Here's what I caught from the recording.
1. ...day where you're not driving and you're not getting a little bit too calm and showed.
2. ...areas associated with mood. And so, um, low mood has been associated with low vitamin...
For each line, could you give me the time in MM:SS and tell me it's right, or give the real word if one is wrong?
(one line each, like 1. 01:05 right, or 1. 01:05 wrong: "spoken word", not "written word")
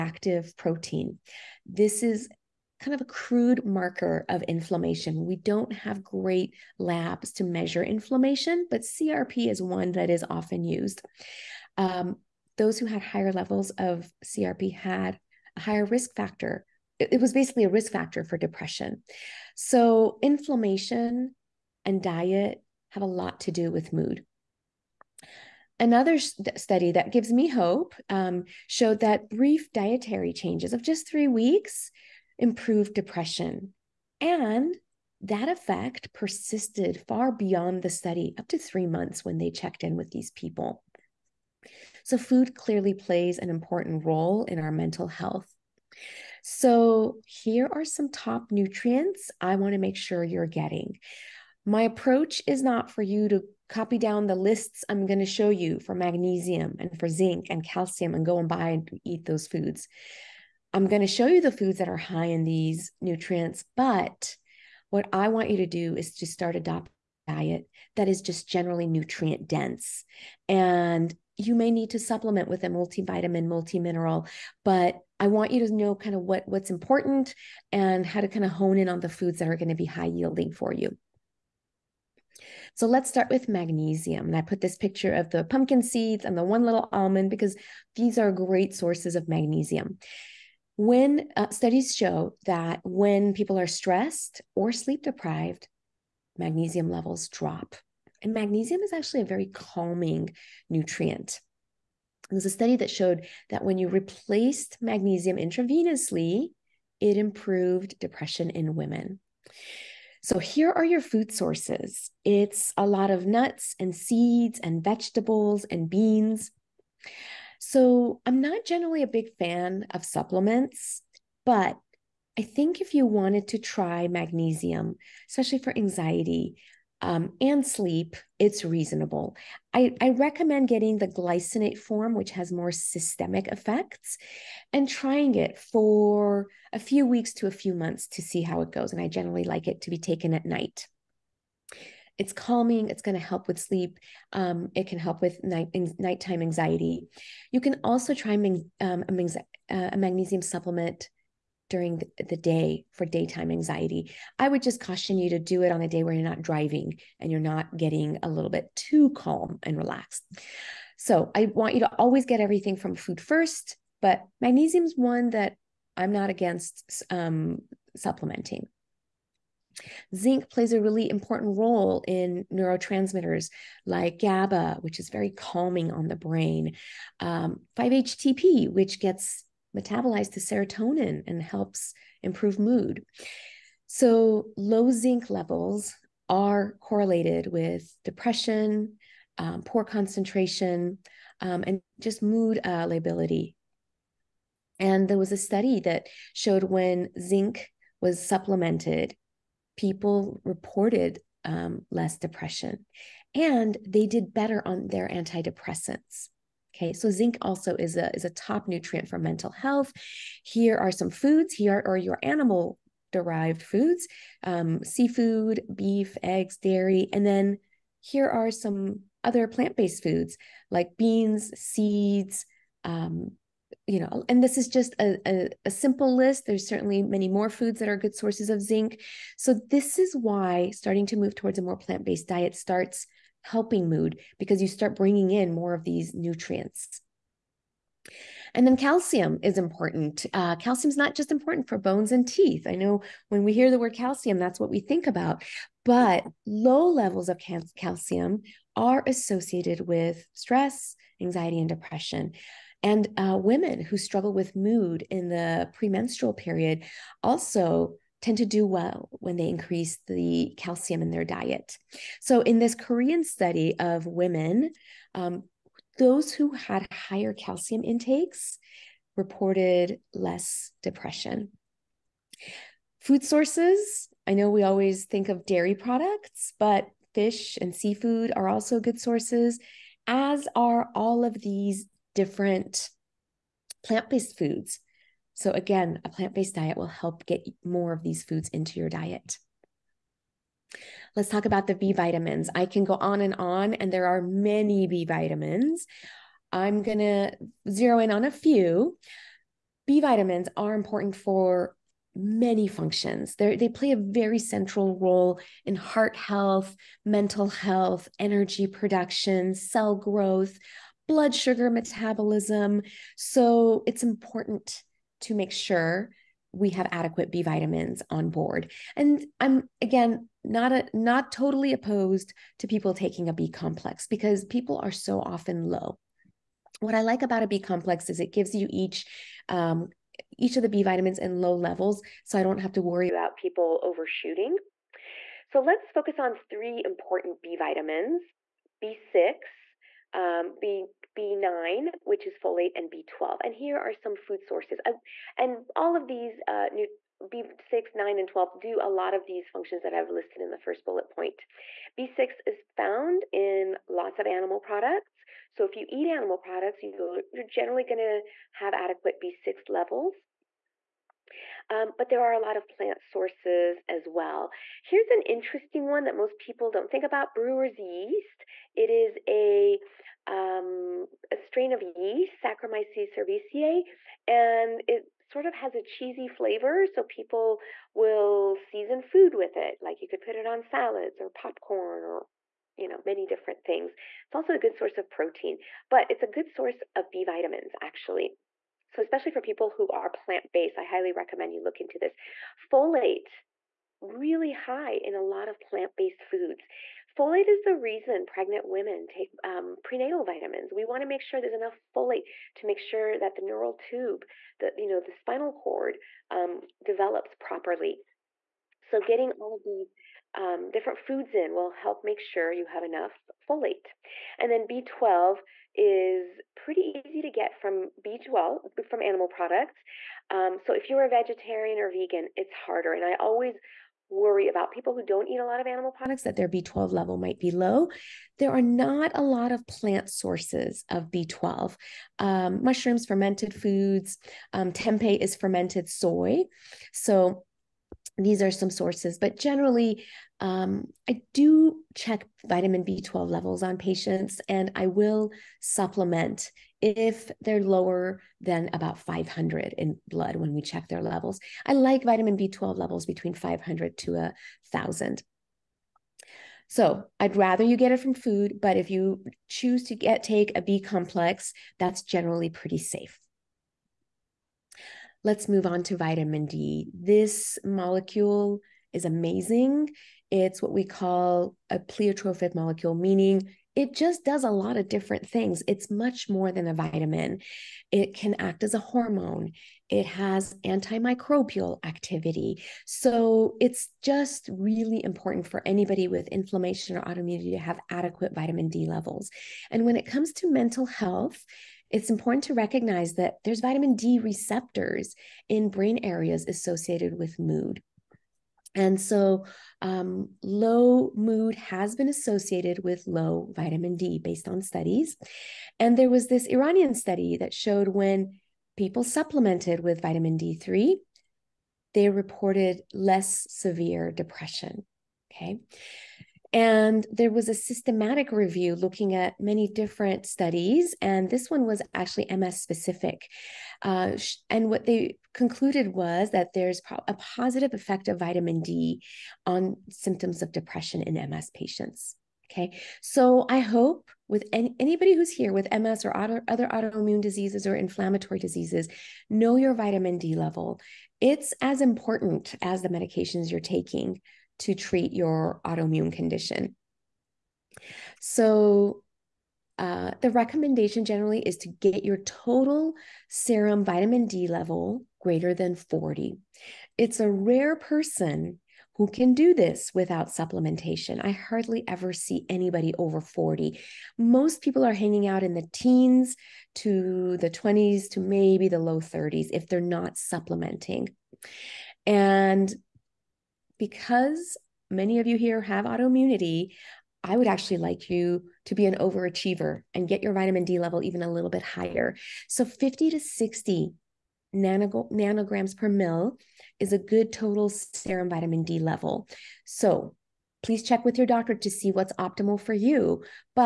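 1. 02:35 wrong: "relaxed", not "showed"
2. 08:16 right.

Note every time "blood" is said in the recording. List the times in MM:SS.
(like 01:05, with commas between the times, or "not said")
05:11, 07:30.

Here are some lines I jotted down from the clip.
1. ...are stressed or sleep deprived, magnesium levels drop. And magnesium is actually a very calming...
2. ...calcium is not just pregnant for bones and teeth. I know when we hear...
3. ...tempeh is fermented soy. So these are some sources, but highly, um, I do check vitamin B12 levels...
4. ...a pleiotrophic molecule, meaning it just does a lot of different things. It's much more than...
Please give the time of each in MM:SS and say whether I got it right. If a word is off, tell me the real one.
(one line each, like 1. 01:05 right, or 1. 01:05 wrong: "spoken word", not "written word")
1. 01:33 right
2. 04:00 wrong: "important", not "pregnant"
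3. 07:14 wrong: "generally", not "highly"
4. 07:51 right.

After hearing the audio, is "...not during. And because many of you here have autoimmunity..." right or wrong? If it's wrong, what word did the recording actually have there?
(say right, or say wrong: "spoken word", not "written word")
wrong: "supplementing", not "during".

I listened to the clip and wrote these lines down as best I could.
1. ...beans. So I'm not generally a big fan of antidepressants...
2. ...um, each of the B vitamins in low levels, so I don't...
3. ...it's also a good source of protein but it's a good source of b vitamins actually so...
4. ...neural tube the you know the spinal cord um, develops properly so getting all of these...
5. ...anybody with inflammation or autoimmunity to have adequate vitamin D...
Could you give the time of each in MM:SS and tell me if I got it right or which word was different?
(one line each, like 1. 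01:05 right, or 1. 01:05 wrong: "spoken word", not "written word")
1. 01:55 wrong: "supplements", not "antidepressants"
2. 05:29 right
3. 06:24 right
4. 06:43 right
5. 08:05 right.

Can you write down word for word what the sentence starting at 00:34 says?
And that effect persisted far beyond the study, up to three months when they checked in with these people.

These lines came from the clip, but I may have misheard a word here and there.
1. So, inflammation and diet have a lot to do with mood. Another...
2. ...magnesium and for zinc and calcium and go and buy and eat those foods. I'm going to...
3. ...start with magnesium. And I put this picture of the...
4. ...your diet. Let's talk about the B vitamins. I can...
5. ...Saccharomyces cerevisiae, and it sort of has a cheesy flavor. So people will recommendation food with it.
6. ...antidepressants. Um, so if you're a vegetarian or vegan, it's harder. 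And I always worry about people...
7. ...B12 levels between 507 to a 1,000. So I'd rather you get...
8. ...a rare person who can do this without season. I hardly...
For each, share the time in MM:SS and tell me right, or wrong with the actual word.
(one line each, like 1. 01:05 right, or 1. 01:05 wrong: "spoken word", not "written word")
1. 00:19 right
2. 00:55 right
3. 01:23 right
4. 04:48 right
5. 06:12 wrong: "season", not "recommendation"
6. 06:59 wrong: "products", not "antidepressants"
7. 07:32 wrong: "500", not "507"
8. 09:17 wrong: "supplementation", not "season".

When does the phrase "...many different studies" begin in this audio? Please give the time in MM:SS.
08:39.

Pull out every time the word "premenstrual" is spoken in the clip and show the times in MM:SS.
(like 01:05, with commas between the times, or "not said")
04:15.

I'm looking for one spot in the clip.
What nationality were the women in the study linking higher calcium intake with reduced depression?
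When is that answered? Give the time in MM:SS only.
04:22.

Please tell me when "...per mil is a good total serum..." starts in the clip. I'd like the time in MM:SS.
09:45.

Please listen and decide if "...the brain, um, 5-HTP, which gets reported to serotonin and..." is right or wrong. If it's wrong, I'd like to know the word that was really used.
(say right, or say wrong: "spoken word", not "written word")
wrong: "metabolized", not "reported".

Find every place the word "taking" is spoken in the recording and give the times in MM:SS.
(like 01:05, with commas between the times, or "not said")
05:22, 09:03.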